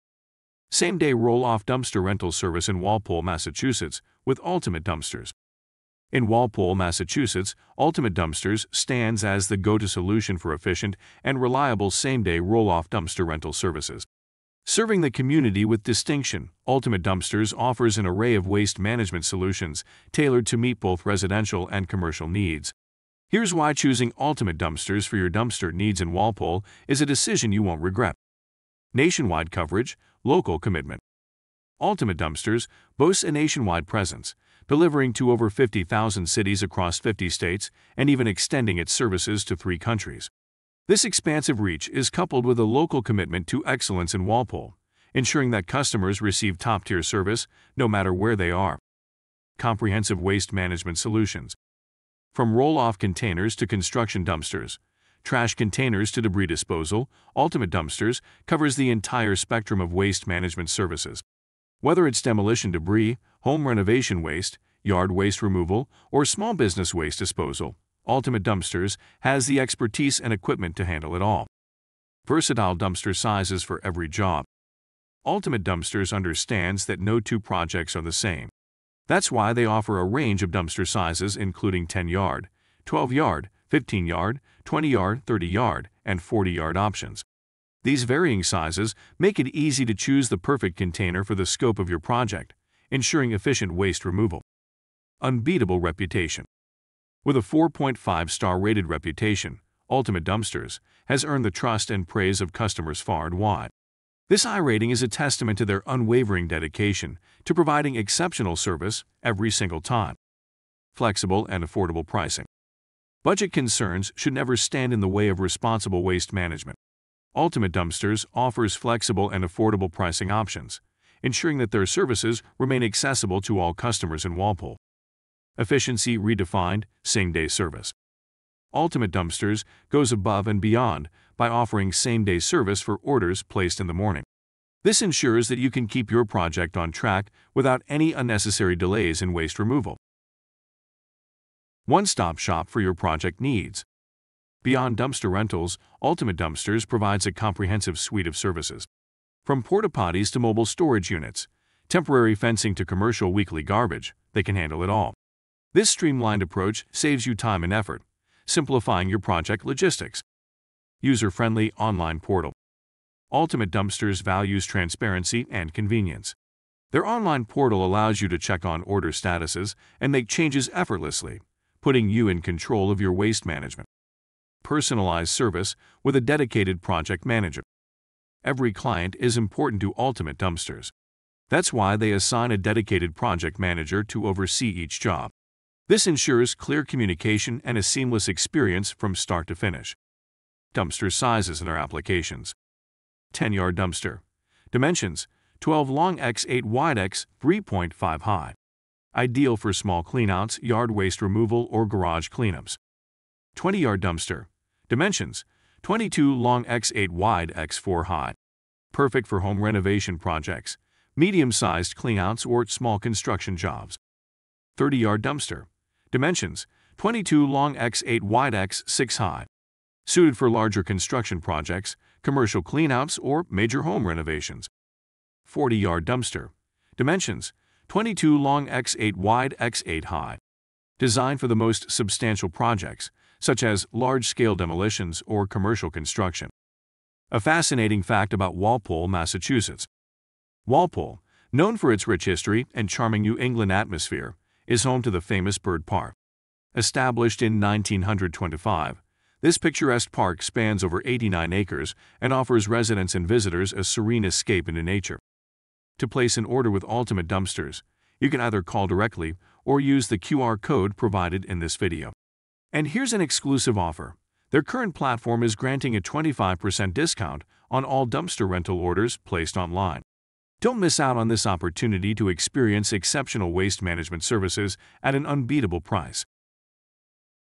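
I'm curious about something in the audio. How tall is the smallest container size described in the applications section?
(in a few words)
3.5 high.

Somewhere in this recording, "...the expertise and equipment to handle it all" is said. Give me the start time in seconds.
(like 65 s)
69 s.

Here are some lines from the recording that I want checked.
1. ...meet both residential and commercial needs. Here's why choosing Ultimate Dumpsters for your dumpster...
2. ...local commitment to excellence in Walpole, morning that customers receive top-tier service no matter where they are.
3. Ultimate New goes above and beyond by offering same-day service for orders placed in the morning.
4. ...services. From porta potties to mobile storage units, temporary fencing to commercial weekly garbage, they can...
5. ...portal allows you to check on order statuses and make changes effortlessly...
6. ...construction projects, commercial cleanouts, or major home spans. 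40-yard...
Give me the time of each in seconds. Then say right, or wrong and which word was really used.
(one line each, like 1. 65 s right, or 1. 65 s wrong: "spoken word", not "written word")
1. 20 s right
2. 42 s wrong: "ensuring", not "morning"
3. 128 s wrong: "Dumpsters", not "New"
4. 148 s right
5. 167 s right
6. 220 s wrong: "renovations", not "spans".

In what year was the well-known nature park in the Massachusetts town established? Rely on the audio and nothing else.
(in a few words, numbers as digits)
1925.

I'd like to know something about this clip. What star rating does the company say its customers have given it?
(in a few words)
4.5 star.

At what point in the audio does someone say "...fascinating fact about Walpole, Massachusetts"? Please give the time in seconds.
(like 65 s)
237 s.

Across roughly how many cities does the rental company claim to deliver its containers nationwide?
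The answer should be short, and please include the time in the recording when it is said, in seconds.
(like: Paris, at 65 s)
50,000, at 35 s.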